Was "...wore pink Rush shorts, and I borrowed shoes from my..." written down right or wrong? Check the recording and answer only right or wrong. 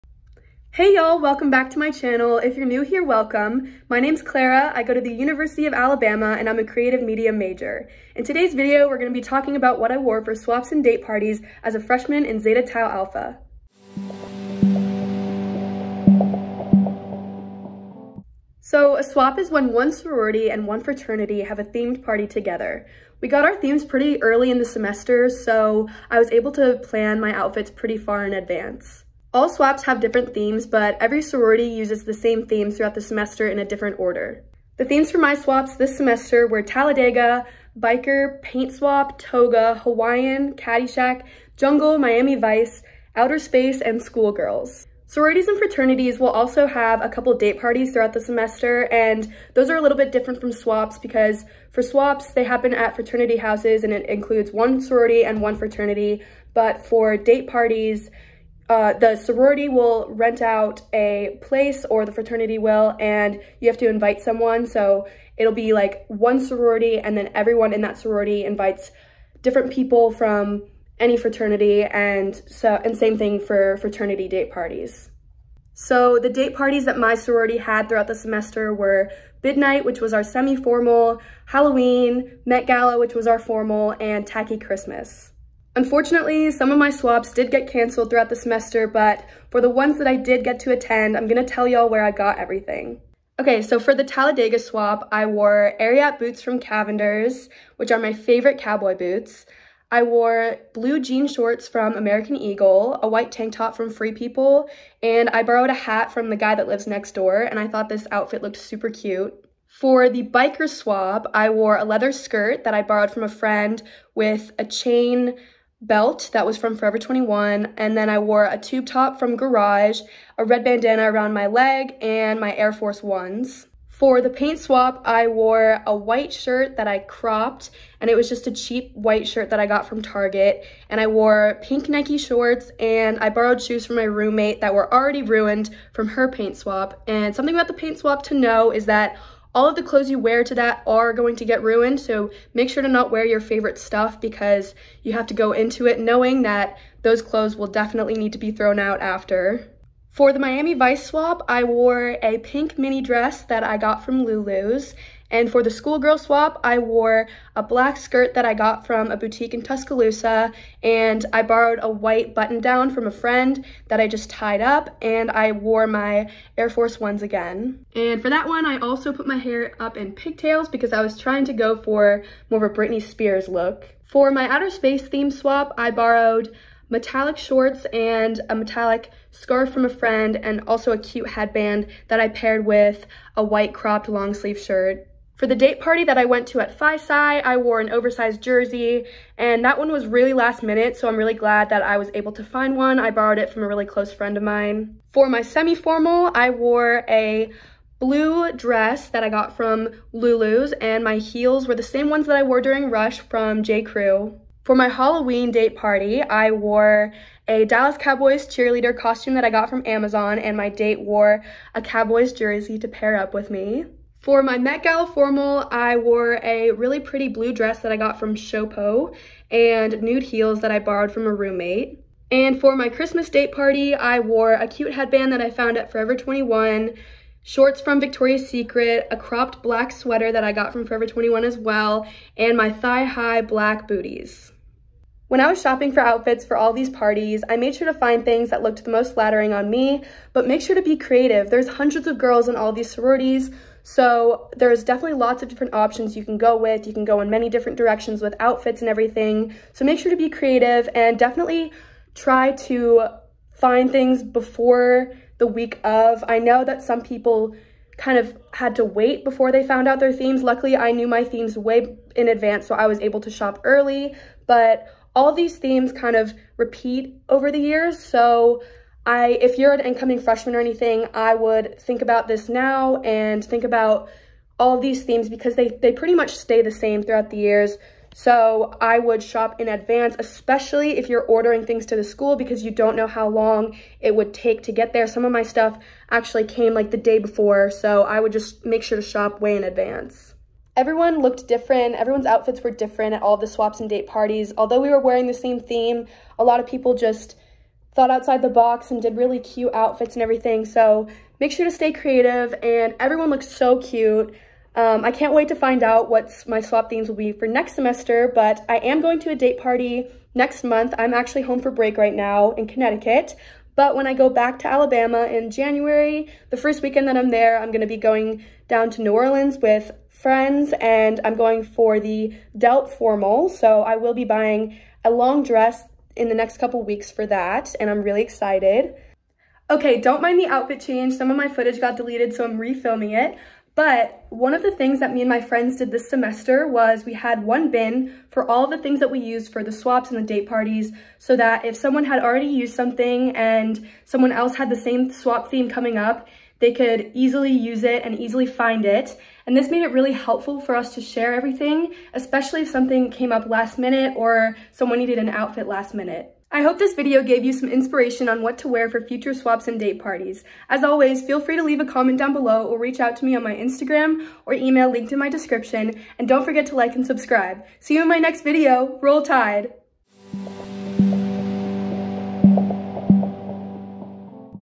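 wrong.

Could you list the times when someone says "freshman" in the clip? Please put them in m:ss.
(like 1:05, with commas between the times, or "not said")
0:11, 4:30.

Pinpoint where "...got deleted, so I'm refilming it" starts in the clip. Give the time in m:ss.
5:31.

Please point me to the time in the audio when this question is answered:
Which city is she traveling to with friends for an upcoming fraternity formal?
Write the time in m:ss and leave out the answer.
5:19.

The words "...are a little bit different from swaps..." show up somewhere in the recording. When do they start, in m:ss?
0:49.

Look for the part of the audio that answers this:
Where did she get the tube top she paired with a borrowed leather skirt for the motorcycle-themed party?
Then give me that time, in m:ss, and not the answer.
1:59.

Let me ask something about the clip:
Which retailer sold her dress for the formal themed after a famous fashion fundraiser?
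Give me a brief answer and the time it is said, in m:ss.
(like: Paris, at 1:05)
Showpo, at 3:38.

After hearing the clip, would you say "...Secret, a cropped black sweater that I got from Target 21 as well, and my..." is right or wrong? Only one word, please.
wrong.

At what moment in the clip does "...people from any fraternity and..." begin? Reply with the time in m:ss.
1:09.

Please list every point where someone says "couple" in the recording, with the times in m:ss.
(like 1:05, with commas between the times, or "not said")
0:47, 5:26.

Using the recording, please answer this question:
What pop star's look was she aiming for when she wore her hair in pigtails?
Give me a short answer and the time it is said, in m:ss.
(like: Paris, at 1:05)
Britney Spears, at 2:52.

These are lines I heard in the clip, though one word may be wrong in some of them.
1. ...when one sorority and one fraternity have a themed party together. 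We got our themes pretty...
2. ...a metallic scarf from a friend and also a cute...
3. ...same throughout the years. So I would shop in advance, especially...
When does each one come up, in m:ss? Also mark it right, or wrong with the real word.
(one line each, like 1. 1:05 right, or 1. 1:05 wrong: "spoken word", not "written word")
1. 0:19 right
2. 2:58 right
3. 4:36 right.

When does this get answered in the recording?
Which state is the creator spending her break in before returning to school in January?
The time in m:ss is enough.
5:12.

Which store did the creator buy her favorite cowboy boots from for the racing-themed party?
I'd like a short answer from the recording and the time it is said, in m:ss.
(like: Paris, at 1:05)
Cavender's, at 1:36.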